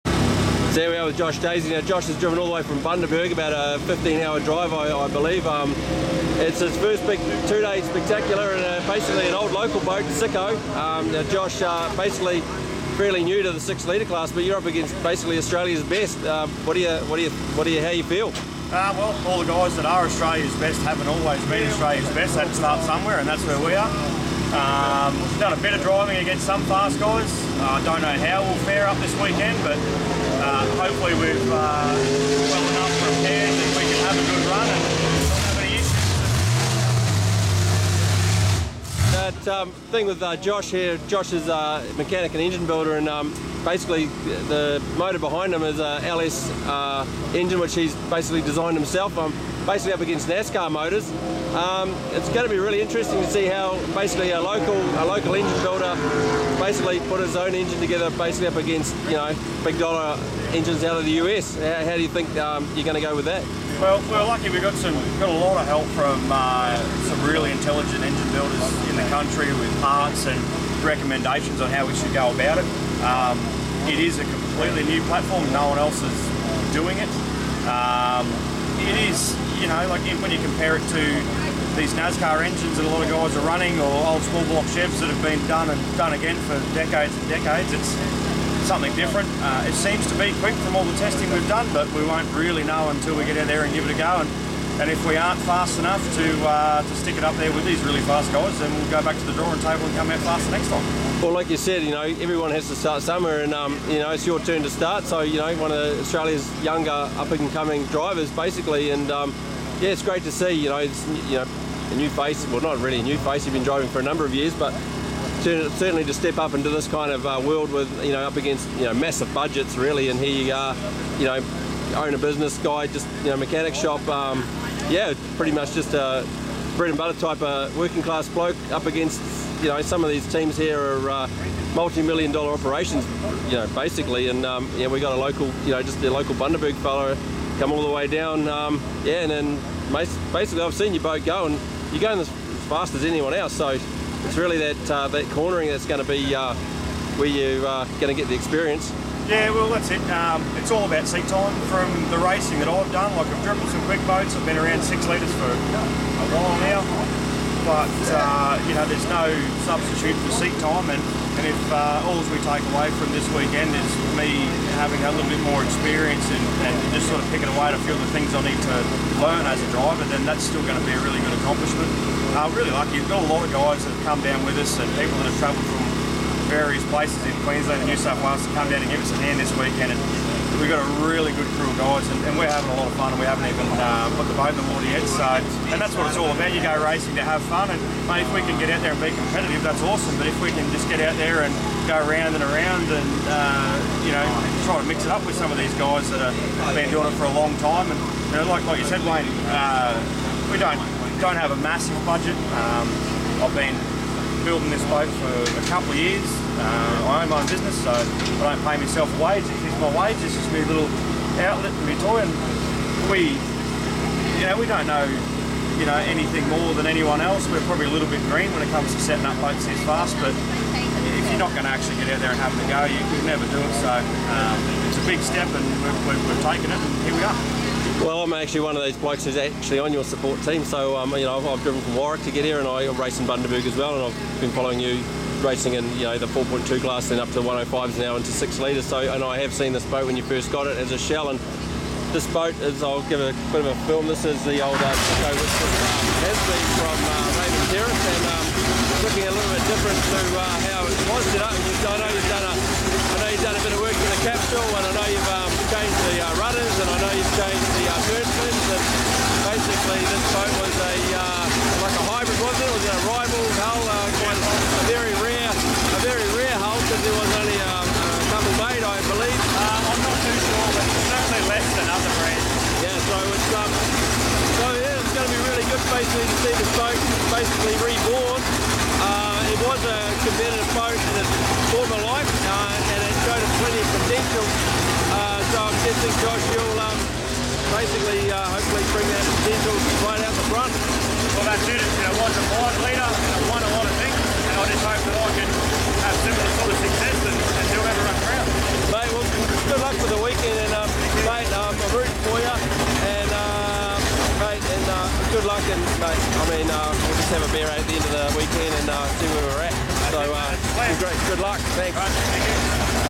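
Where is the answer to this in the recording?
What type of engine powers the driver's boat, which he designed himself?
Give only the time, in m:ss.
0:46.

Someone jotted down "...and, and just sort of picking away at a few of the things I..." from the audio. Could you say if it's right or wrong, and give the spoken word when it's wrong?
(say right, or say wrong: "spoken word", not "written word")
right.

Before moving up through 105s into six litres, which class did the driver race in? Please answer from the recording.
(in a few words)
4.2.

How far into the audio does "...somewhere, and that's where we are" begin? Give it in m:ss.
0:22.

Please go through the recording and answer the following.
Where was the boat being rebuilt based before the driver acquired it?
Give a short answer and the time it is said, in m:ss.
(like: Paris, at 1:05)
Raymond Terrace, at 4:07.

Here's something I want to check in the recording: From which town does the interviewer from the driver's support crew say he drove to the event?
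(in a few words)
Warwick.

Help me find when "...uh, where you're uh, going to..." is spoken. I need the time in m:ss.
2:26.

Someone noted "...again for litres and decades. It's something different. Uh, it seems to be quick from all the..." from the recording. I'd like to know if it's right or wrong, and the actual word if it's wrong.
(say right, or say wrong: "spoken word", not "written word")
wrong: "decades", not "litres".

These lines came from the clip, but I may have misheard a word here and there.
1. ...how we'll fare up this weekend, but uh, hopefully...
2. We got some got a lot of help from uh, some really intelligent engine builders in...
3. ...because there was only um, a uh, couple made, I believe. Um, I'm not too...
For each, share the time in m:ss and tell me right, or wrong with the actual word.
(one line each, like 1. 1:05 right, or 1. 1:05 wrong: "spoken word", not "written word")
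1. 0:28 right
2. 1:04 right
3. 4:26 right.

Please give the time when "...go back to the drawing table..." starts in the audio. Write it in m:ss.
1:38.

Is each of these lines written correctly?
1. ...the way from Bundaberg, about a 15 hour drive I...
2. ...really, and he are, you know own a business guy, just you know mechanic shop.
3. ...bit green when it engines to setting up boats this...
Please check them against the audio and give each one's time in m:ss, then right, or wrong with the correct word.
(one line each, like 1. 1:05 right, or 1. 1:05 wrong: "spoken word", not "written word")
1. 0:02 right
2. 1:59 right
3. 3:38 wrong: "comes", not "engines".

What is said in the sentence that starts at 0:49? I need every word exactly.
I'm um, basically up against NASCAR motors.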